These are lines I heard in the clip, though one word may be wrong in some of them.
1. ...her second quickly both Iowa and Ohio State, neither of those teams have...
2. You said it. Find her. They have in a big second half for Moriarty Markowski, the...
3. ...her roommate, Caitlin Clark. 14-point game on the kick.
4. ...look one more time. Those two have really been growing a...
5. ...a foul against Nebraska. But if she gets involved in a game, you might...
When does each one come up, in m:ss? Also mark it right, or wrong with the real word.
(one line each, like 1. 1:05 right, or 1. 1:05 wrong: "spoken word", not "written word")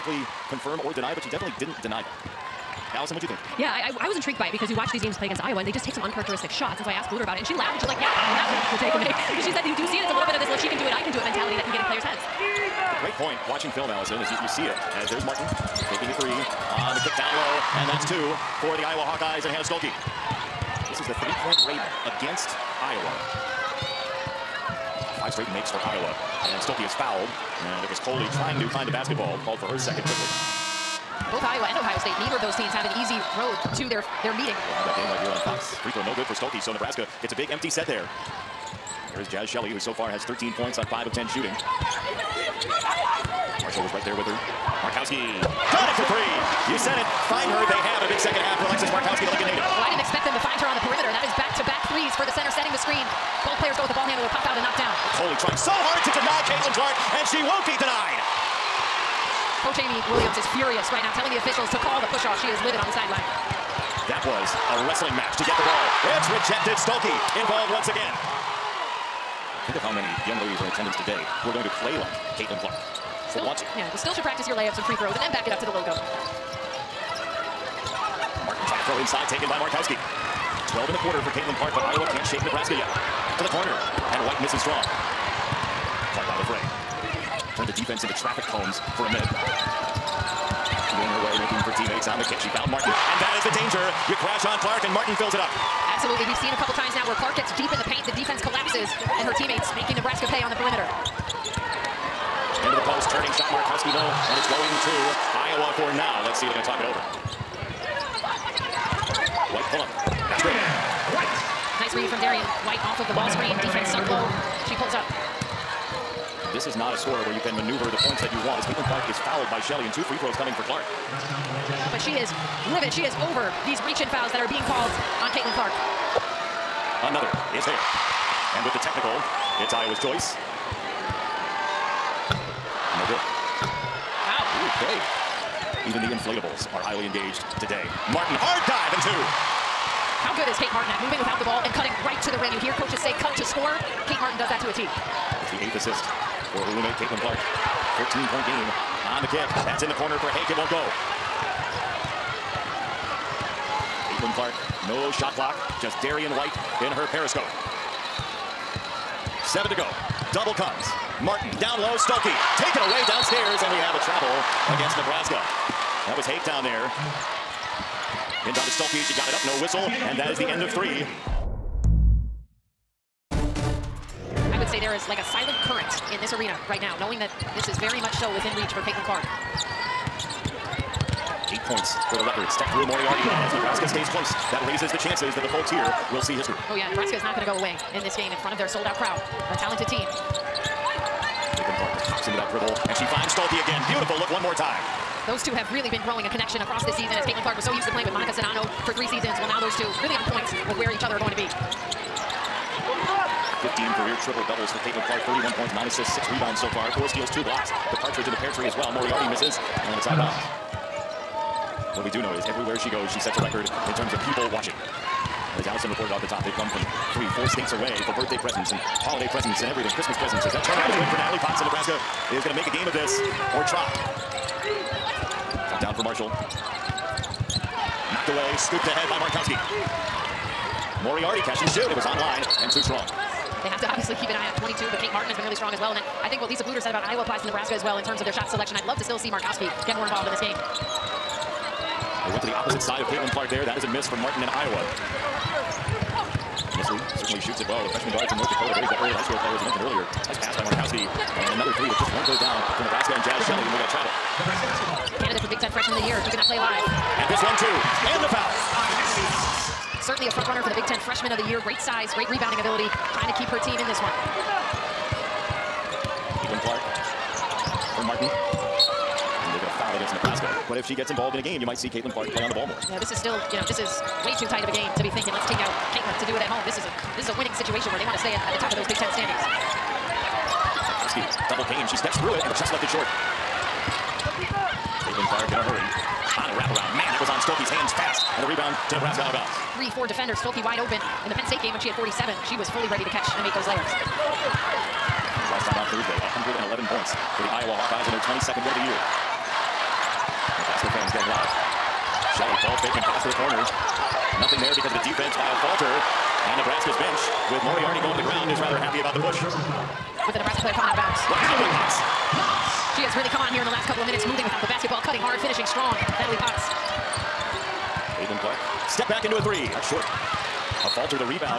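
1. 0:29 right
2. 0:46 wrong: "Alexis", not "Moriarty"
3. 2:26 right
4. 3:14 right
5. 4:29 right.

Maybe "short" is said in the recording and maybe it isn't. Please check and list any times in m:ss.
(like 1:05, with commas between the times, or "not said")
4:42, 5:19.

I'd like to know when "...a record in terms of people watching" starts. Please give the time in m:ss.
3:33.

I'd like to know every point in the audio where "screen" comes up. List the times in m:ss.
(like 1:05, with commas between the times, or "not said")
0:52, 1:53.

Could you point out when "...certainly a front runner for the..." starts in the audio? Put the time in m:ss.
4:20.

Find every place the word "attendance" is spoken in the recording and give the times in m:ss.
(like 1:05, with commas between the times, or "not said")
1:10.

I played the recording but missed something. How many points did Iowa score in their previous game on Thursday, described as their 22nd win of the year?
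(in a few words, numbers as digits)
111.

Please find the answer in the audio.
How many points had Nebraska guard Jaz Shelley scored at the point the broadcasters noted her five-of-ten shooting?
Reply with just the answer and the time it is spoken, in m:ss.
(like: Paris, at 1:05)
13, at 0:40.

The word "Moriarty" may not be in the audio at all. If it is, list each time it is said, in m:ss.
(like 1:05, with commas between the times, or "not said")
3:02, 3:28, 3:51, 5:07.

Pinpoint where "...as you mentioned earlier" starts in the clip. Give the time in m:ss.
4:09.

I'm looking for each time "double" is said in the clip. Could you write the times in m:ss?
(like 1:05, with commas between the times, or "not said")
2:40, 3:24, 4:41.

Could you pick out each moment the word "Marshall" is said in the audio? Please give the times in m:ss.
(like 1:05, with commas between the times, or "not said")
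0:43, 3:46.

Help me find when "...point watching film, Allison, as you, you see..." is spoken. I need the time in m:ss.
0:13.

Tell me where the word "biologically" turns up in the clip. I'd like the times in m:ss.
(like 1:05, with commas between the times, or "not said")
not said.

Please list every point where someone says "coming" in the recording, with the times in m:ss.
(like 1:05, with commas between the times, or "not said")
2:00, 5:10.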